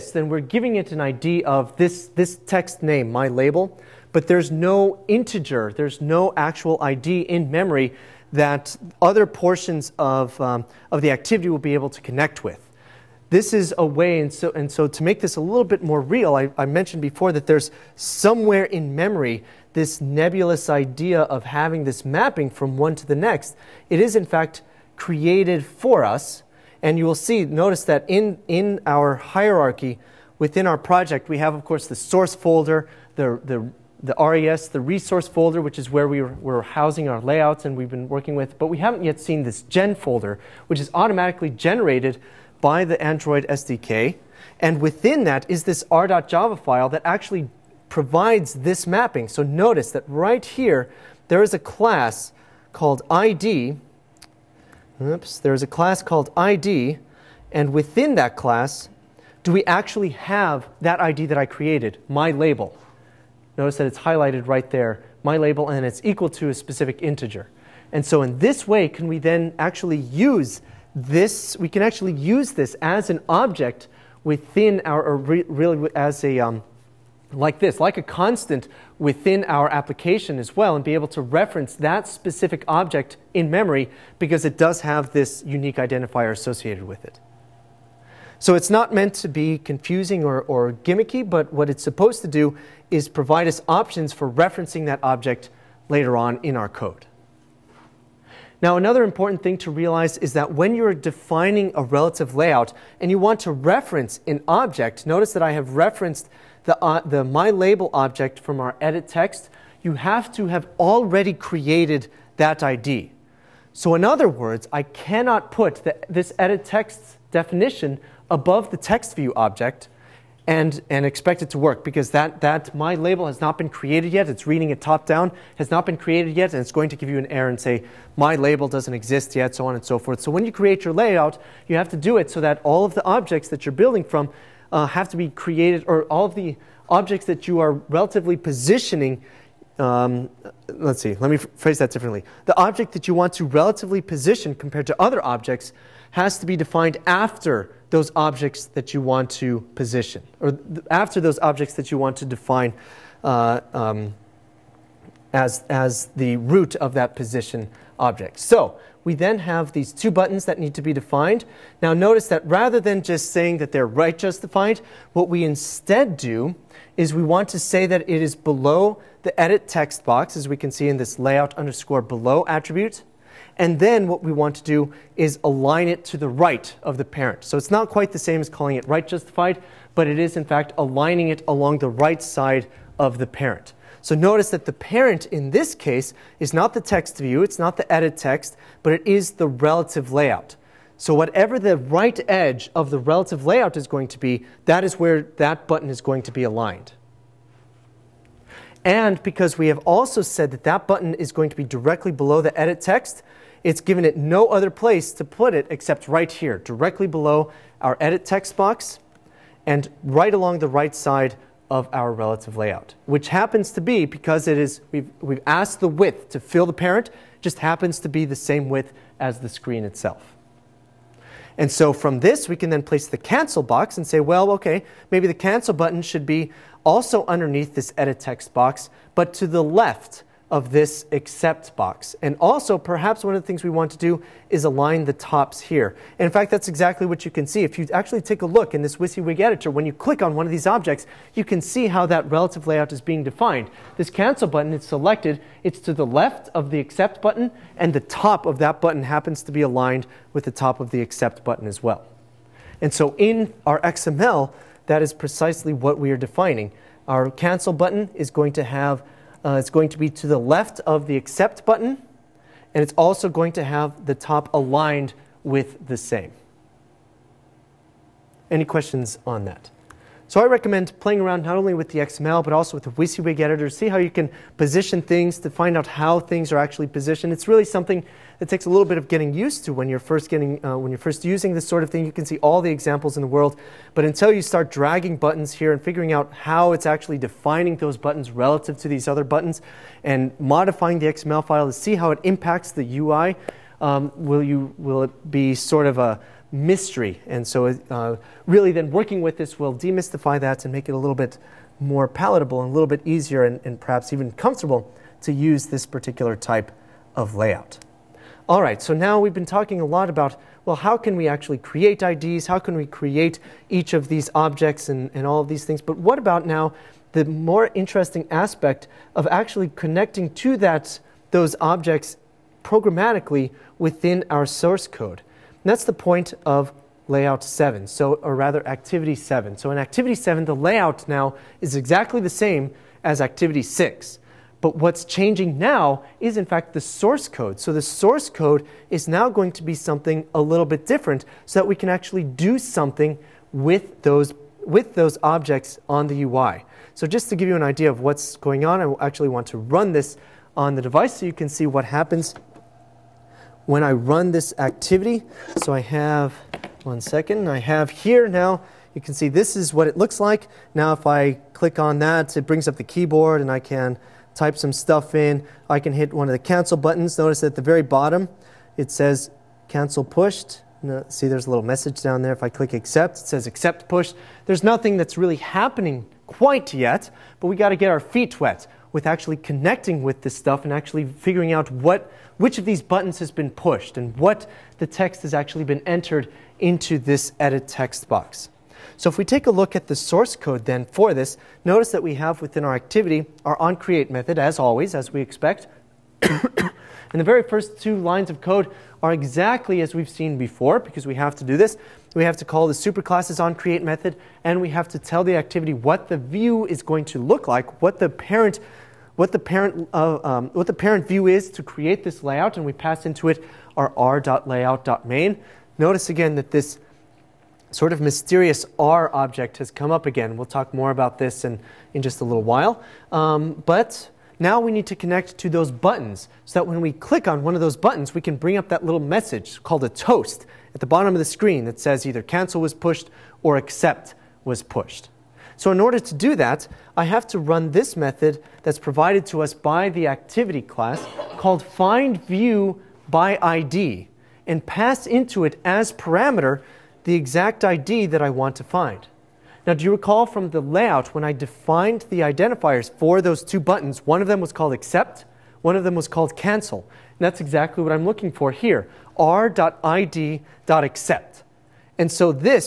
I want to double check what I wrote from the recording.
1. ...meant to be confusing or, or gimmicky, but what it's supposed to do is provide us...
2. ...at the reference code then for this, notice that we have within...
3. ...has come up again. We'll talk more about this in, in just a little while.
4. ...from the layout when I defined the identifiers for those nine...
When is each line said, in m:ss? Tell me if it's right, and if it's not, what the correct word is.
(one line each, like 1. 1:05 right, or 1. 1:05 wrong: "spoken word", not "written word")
1. 1:28 right
2. 6:29 wrong: "source", not "reference"
3. 6:59 right
4. 7:30 wrong: "two", not "nine".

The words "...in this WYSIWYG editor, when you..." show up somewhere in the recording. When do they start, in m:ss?
3:58.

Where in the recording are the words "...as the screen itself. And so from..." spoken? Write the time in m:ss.
3:39.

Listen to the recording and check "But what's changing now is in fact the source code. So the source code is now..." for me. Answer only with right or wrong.
right.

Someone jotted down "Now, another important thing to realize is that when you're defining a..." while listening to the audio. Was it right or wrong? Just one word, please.
right.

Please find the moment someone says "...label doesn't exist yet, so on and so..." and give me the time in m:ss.
2:08.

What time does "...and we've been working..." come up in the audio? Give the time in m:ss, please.
0:37.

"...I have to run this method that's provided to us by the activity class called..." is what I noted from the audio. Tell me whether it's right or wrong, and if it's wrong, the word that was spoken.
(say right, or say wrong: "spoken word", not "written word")
right.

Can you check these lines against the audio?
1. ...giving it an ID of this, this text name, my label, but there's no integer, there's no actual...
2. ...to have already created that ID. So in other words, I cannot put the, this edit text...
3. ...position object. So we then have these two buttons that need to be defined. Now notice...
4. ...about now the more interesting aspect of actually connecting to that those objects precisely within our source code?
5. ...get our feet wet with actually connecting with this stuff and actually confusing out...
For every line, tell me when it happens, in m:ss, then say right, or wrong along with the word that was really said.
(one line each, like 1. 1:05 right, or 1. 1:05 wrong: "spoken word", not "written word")
1. 0:00 right
2. 1:50 right
3. 2:37 right
4. 5:16 wrong: "programmatically", not "precisely"
5. 6:17 wrong: "figuring", not "confusing".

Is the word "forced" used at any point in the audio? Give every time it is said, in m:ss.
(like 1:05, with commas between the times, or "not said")
not said.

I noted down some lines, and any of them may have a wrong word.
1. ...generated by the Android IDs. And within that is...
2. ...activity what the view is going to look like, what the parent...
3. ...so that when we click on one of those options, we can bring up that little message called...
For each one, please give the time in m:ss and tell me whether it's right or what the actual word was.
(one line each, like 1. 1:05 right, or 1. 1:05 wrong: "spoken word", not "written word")
1. 0:41 wrong: "SDK", not "IDs"
2. 6:45 right
3. 7:06 wrong: "buttons", not "options".